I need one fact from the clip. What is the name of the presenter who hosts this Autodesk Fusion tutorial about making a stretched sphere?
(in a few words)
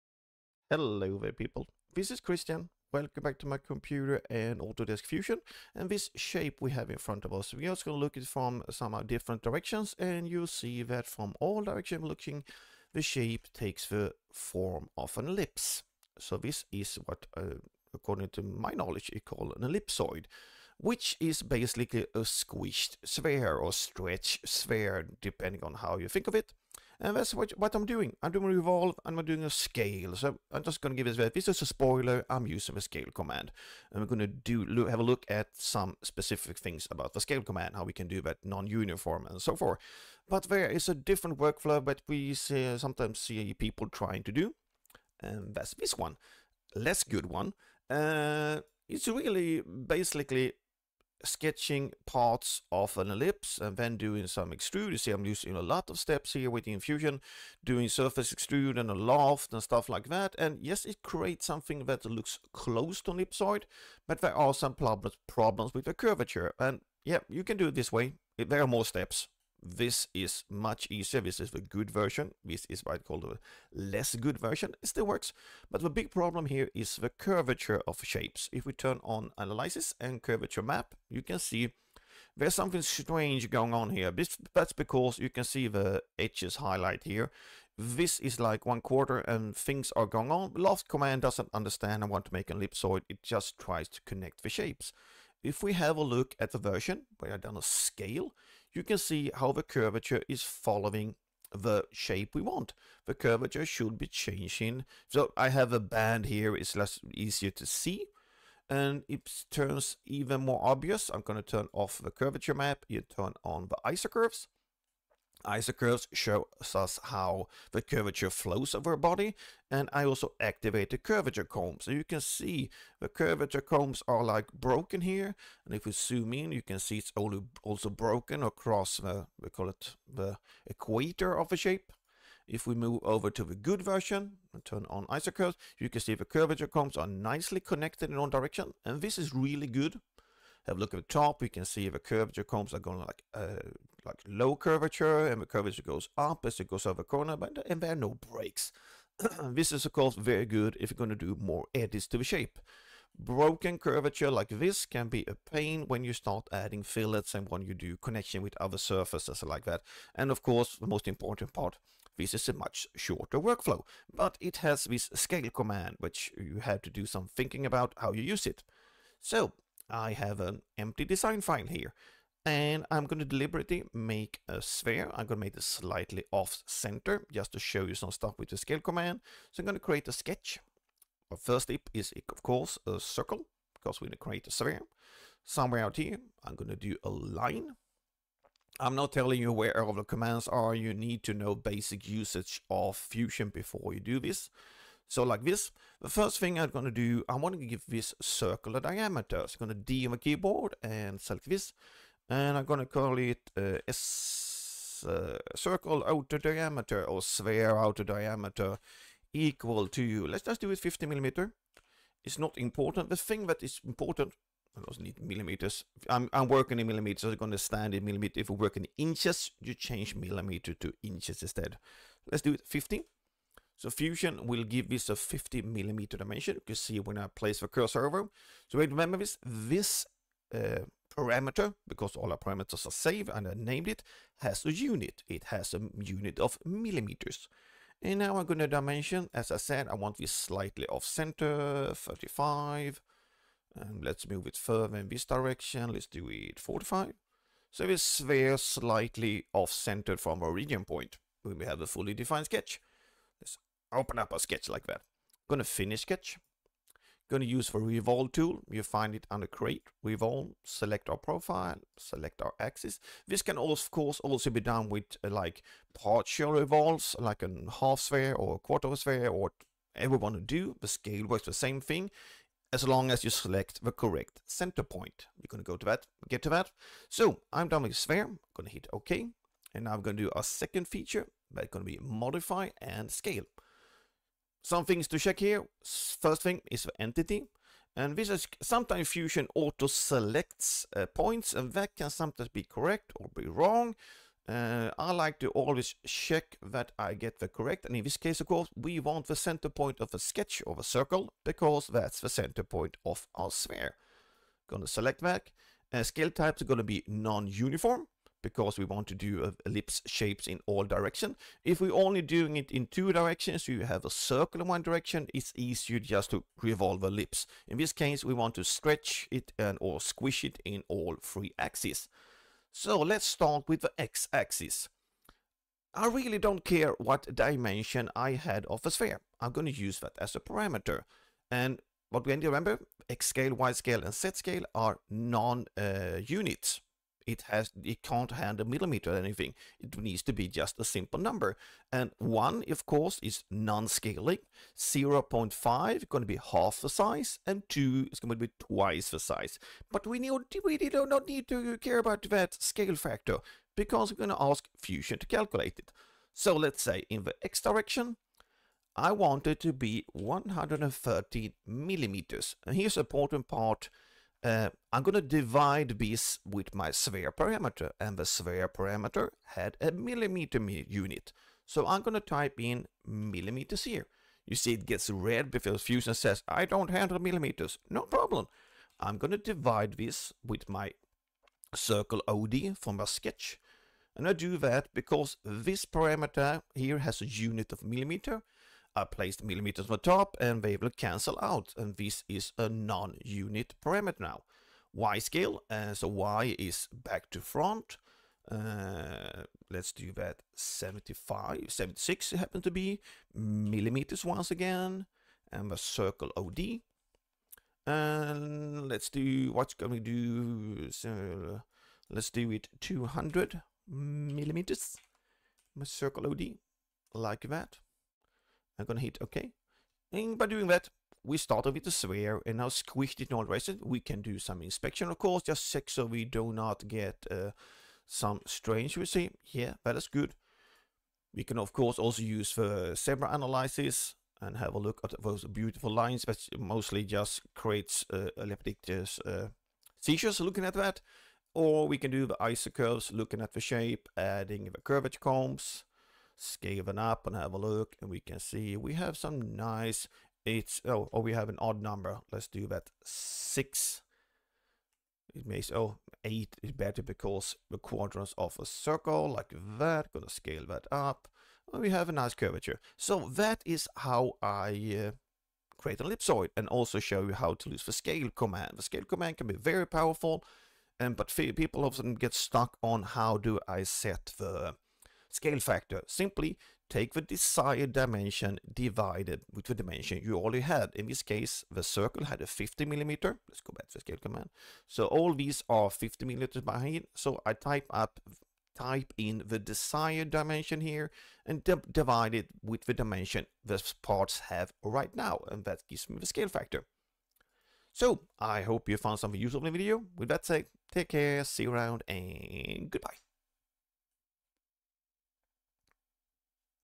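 Kristian.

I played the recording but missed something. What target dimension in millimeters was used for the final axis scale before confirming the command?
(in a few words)
200 millimeters.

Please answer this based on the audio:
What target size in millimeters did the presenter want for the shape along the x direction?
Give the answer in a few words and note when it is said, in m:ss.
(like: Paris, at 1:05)
130 millimeters, at 6:00.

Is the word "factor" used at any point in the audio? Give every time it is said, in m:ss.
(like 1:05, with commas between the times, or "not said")
5:52, 7:55, 8:16.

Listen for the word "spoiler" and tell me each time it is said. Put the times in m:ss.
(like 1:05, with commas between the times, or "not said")
0:31.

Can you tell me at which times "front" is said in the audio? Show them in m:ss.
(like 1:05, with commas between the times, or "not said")
0:06, 6:37.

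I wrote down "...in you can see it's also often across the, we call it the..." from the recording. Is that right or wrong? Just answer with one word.
wrong.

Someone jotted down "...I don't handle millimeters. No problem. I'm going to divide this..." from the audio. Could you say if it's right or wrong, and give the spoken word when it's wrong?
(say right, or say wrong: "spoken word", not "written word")
right.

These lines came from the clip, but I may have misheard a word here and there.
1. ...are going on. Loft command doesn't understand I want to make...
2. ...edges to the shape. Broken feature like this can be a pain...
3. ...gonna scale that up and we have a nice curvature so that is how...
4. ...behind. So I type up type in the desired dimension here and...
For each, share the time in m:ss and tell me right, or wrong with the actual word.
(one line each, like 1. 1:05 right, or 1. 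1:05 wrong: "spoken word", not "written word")
1. 1:29 right
2. 2:31 wrong: "curvature", not "feature"
3. 7:40 right
4. 8:06 right.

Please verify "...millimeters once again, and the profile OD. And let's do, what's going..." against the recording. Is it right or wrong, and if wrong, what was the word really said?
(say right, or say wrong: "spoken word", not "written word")
wrong: "circle", not "profile".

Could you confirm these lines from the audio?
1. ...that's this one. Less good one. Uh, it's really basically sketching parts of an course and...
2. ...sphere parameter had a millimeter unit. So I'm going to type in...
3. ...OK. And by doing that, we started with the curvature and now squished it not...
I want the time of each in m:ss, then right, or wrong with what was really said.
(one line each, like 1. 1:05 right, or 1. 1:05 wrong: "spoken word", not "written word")
1. 0:45 wrong: "ellipse", not "course"
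2. 6:08 right
3. 6:59 wrong: "sphere", not "curvature".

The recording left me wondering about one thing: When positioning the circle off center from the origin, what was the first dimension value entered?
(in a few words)
35.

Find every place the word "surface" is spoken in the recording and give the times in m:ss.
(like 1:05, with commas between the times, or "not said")
0:57, 2:38.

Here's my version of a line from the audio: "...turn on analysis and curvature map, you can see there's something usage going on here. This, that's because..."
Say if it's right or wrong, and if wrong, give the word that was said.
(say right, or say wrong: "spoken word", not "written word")
wrong: "strange", not "usage".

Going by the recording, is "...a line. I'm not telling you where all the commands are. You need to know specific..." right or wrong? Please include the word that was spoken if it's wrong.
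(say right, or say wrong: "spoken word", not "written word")
wrong: "basic", not "specific".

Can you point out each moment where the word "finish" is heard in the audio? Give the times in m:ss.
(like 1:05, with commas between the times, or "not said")
4:15.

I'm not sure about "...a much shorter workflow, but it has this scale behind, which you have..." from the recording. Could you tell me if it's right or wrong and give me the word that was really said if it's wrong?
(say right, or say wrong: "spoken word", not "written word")
wrong: "command", not "behind".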